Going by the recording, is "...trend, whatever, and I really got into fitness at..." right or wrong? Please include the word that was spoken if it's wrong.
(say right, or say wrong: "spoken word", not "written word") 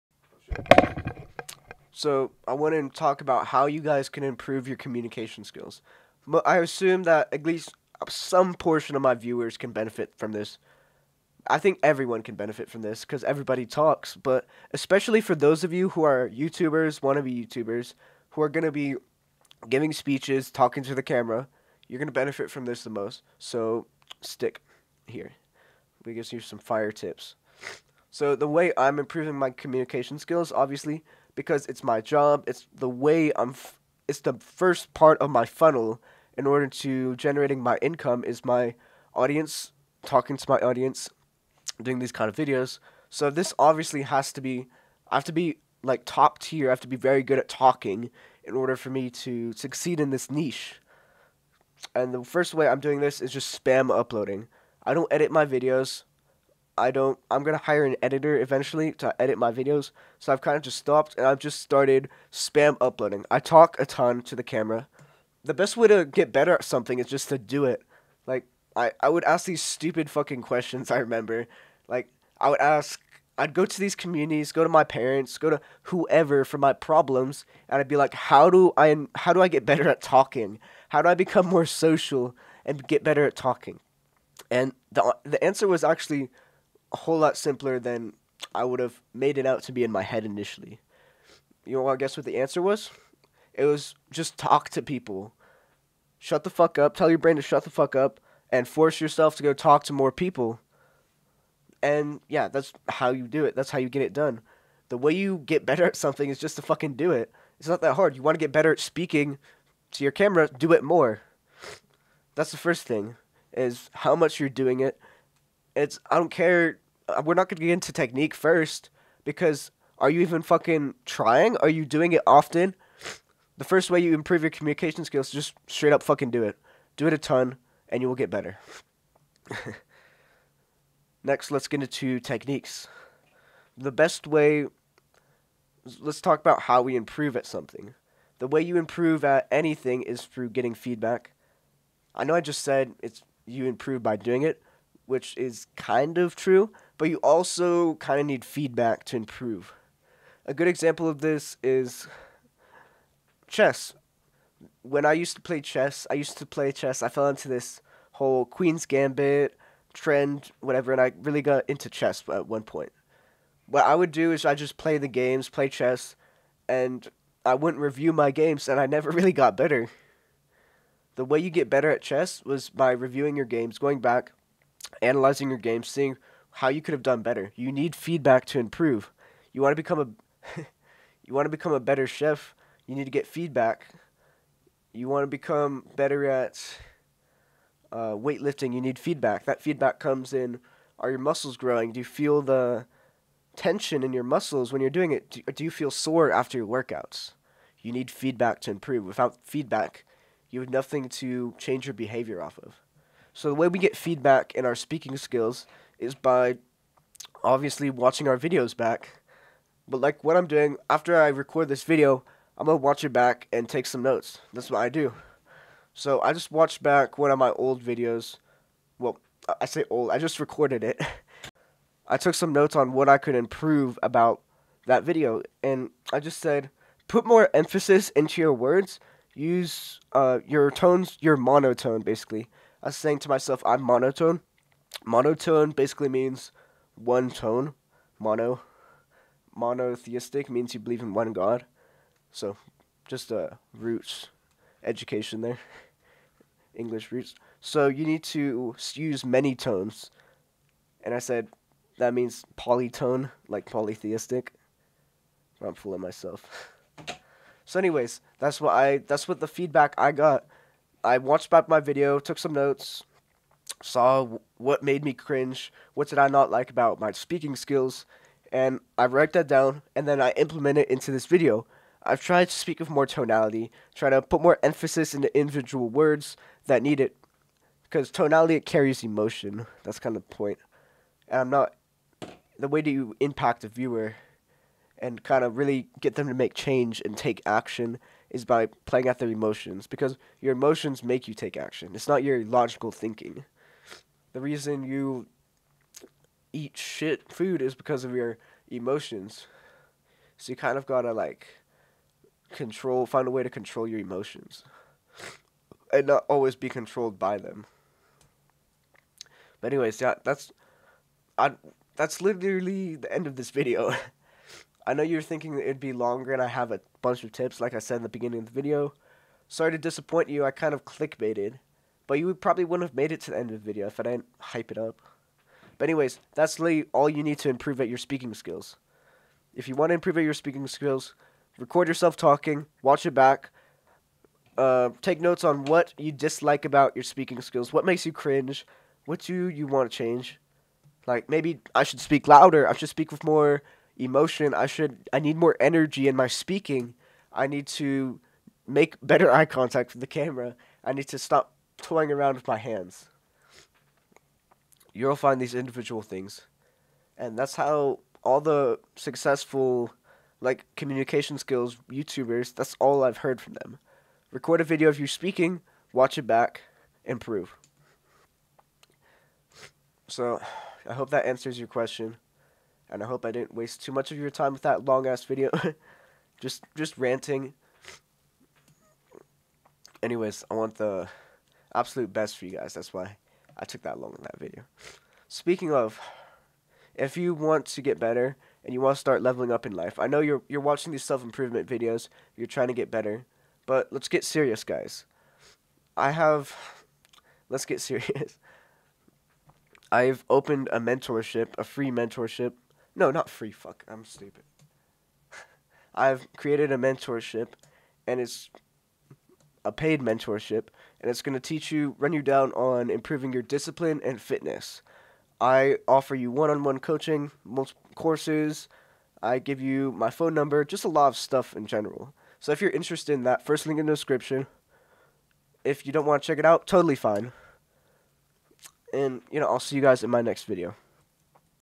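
wrong: "chess", not "fitness".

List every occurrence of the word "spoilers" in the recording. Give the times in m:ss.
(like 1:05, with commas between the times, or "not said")
not said.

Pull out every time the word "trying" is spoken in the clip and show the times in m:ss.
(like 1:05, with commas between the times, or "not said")
2:01, 6:32.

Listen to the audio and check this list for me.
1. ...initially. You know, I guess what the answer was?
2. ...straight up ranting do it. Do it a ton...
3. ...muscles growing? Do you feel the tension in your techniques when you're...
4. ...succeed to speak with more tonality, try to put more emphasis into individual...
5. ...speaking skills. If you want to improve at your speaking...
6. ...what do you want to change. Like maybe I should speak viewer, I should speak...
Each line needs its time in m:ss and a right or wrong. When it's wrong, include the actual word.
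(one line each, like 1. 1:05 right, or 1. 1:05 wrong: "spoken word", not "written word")
1. 1:30 right
2. 2:05 wrong: "fucking", not "ranting"
3. 3:11 wrong: "muscles", not "techniques"
4. 4:32 wrong: "tried", not "succeed"
5. 5:27 right
6. 5:39 wrong: "louder", not "viewer".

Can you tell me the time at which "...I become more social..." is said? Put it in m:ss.
1:21.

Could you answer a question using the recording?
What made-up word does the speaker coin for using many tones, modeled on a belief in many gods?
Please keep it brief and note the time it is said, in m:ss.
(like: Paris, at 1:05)
polytone, at 4:12.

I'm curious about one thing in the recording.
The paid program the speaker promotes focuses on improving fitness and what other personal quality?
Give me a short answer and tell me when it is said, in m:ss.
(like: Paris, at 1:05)
discipline, at 6:53.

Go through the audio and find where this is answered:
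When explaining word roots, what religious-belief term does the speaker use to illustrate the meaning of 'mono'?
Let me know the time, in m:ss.
3:59.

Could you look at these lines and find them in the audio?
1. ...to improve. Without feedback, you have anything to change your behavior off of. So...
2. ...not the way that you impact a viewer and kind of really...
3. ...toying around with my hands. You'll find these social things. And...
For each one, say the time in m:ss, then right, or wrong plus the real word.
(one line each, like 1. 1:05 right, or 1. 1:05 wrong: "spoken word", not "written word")
1. 3:18 wrong: "nothing", not "anything"
2. 4:41 right
3. 5:51 wrong: "individual", not "social".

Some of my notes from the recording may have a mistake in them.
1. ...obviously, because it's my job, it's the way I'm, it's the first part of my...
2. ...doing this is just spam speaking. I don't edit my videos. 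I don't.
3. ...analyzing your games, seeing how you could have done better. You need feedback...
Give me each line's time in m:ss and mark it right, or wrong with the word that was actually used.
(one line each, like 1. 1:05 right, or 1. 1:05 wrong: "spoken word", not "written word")
1. 0:30 right
2. 0:52 wrong: "uploading", not "speaking"
3. 2:55 right.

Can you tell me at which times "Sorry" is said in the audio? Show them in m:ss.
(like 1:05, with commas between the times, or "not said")
5:19.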